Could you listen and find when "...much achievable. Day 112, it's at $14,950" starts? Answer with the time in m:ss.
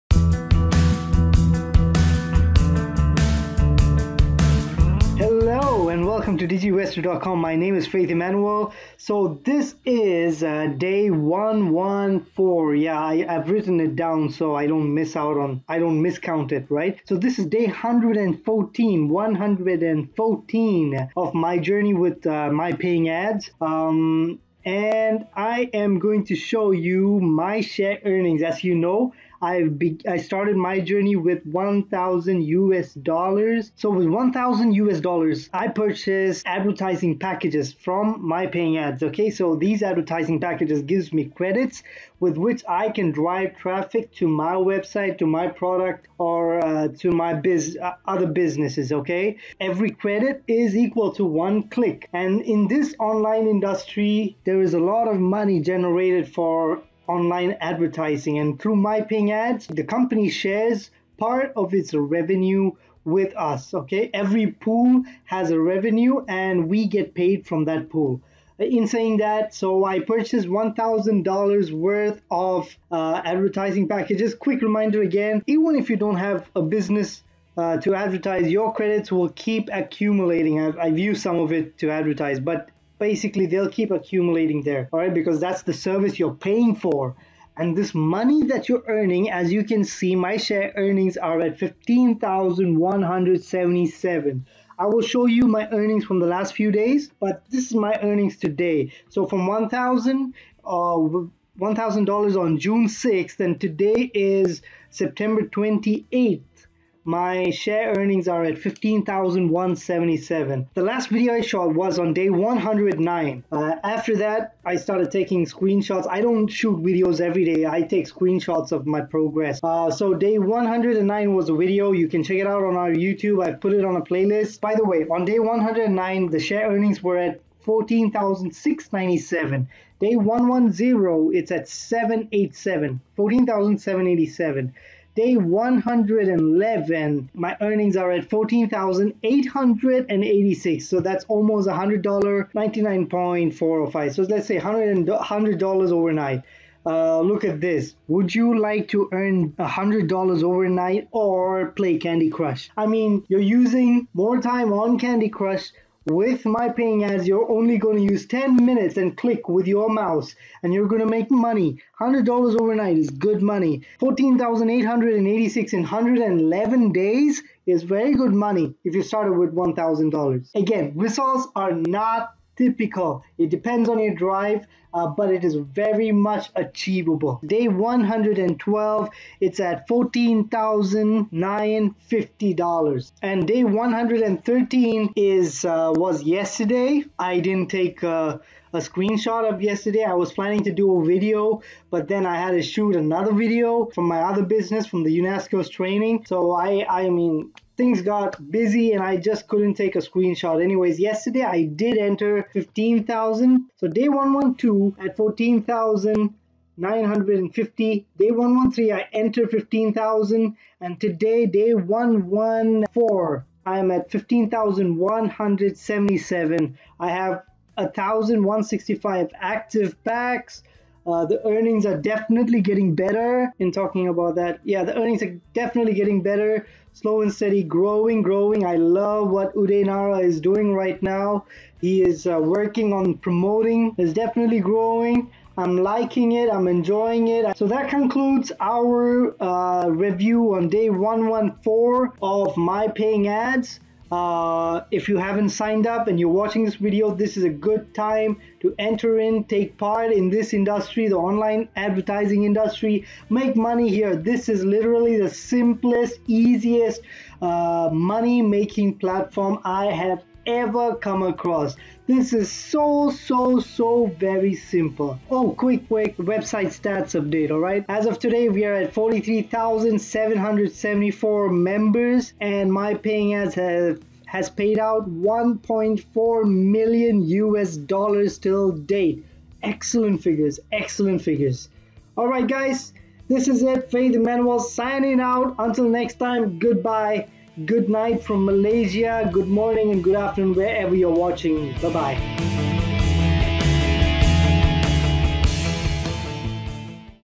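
2:56.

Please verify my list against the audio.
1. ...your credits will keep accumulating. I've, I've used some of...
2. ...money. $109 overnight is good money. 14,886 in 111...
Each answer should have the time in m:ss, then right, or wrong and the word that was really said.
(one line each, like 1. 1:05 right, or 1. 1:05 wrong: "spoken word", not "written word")
1. 1:18 right
2. 2:41 wrong: "100", not "109".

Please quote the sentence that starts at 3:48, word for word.
I love what Uday Nara is doing right now.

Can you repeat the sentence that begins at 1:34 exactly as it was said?
I will show you my earnings from the last few days, but this is my earnings today.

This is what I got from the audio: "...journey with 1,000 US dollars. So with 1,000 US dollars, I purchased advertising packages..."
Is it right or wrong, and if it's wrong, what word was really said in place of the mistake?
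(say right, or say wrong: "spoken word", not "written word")
right.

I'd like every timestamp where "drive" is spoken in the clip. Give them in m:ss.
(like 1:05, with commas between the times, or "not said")
0:43, 2:54.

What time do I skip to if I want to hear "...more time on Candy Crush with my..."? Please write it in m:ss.
2:34.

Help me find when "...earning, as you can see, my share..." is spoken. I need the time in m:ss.
1:28.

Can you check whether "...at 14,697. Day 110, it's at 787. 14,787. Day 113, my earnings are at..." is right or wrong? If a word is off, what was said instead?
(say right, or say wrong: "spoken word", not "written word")
wrong: "111", not "113".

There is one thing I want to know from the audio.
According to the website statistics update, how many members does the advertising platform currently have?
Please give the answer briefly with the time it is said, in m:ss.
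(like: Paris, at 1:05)
43,774, at 4:28.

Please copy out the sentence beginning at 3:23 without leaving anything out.
So day 112 at fourteen thousand nine hundred and fifty.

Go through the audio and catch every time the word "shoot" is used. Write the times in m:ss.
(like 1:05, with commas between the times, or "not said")
1:56, 3:12.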